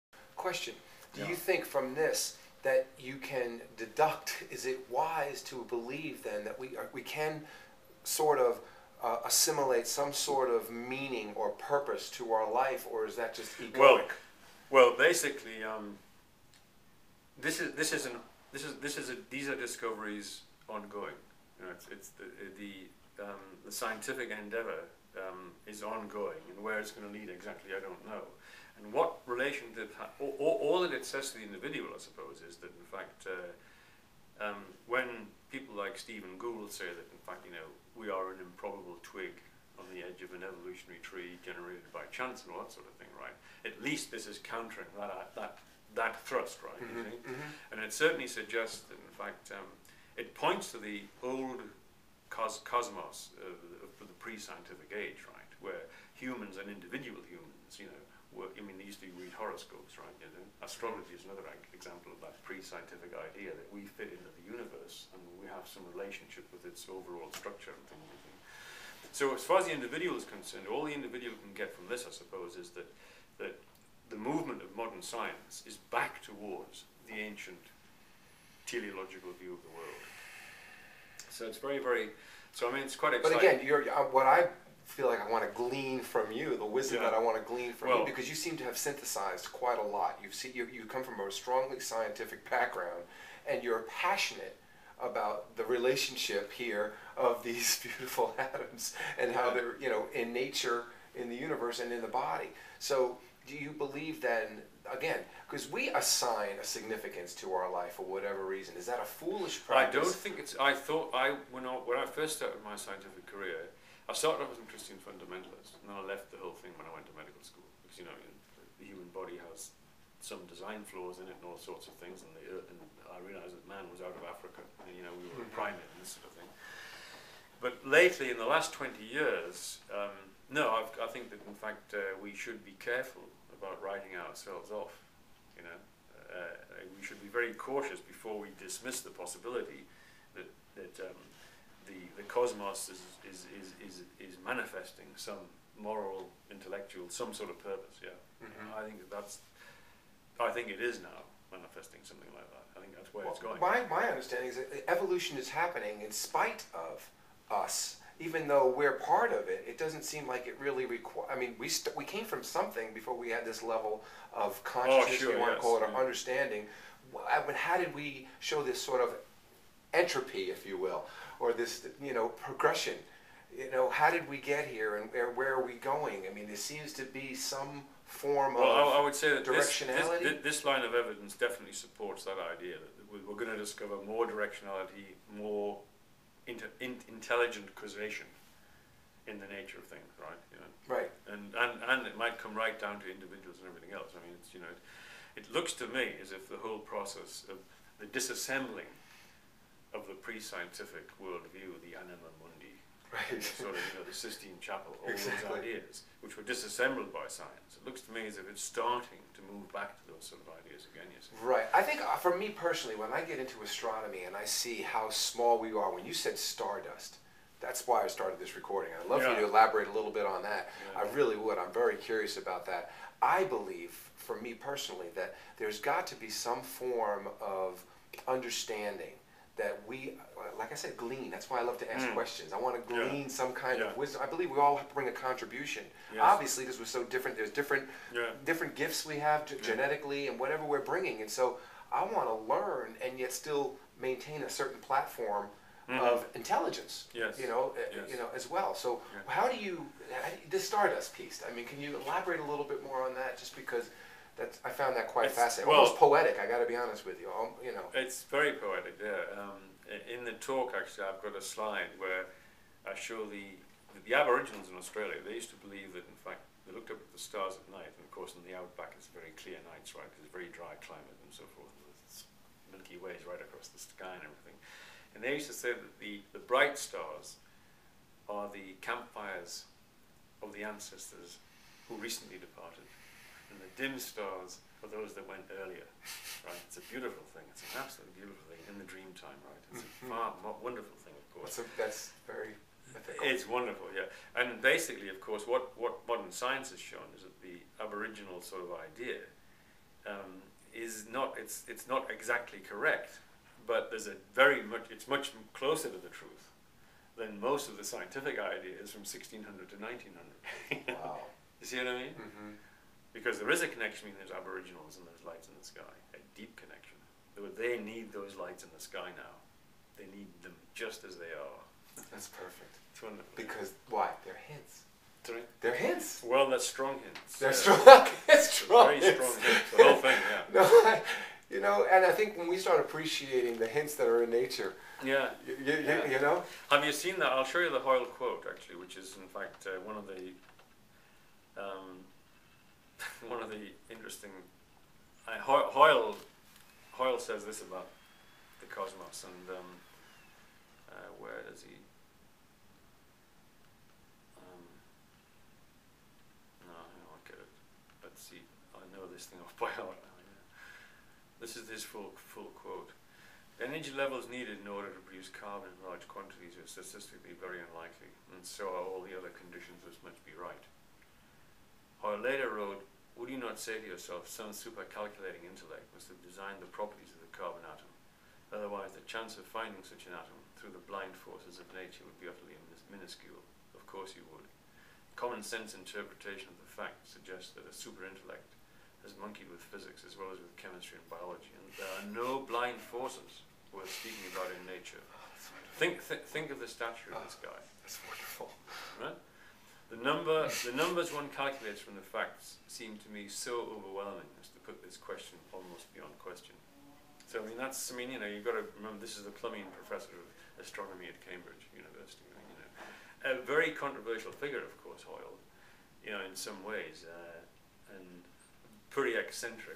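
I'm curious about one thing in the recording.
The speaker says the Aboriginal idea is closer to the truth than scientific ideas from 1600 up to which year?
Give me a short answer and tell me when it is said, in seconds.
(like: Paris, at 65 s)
1900, at 309 s.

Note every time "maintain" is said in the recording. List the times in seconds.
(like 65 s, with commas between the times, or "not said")
244 s.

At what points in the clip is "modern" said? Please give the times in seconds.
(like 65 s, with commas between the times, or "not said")
74 s, 296 s.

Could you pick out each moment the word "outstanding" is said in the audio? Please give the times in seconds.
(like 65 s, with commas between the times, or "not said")
not said.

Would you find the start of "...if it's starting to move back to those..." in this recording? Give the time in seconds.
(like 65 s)
208 s.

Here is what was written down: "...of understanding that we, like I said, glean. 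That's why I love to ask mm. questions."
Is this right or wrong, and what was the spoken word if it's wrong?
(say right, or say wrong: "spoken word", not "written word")
right.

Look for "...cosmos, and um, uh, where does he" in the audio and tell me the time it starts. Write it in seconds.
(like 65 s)
348 s.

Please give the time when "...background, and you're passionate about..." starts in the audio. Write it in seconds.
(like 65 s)
92 s.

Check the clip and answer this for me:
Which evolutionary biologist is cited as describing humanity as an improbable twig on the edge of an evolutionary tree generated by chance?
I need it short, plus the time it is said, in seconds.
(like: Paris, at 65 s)
Stephen Gould, at 35 s.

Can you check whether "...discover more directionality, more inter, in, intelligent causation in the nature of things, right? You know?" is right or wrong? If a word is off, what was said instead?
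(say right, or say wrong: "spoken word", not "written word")
right.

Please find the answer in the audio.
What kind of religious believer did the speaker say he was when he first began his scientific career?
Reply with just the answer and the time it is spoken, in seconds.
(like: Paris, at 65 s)
Christian fundamentalist, at 114 s.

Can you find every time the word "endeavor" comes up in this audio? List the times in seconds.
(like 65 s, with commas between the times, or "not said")
24 s.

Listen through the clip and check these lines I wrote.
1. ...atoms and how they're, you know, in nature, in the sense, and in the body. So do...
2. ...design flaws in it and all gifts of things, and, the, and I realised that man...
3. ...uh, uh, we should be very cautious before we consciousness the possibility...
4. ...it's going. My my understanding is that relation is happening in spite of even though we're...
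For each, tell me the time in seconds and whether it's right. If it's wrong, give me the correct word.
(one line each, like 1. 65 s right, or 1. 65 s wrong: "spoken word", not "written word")
1. 98 s wrong: "universe", not "sense"
2. 120 s wrong: "sorts", not "gifts"
3. 136 s wrong: "dismiss", not "consciousness"
4. 153 s wrong: "evolution", not "relation".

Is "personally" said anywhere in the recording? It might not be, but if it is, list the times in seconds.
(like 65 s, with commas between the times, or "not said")
212 s, 224 s.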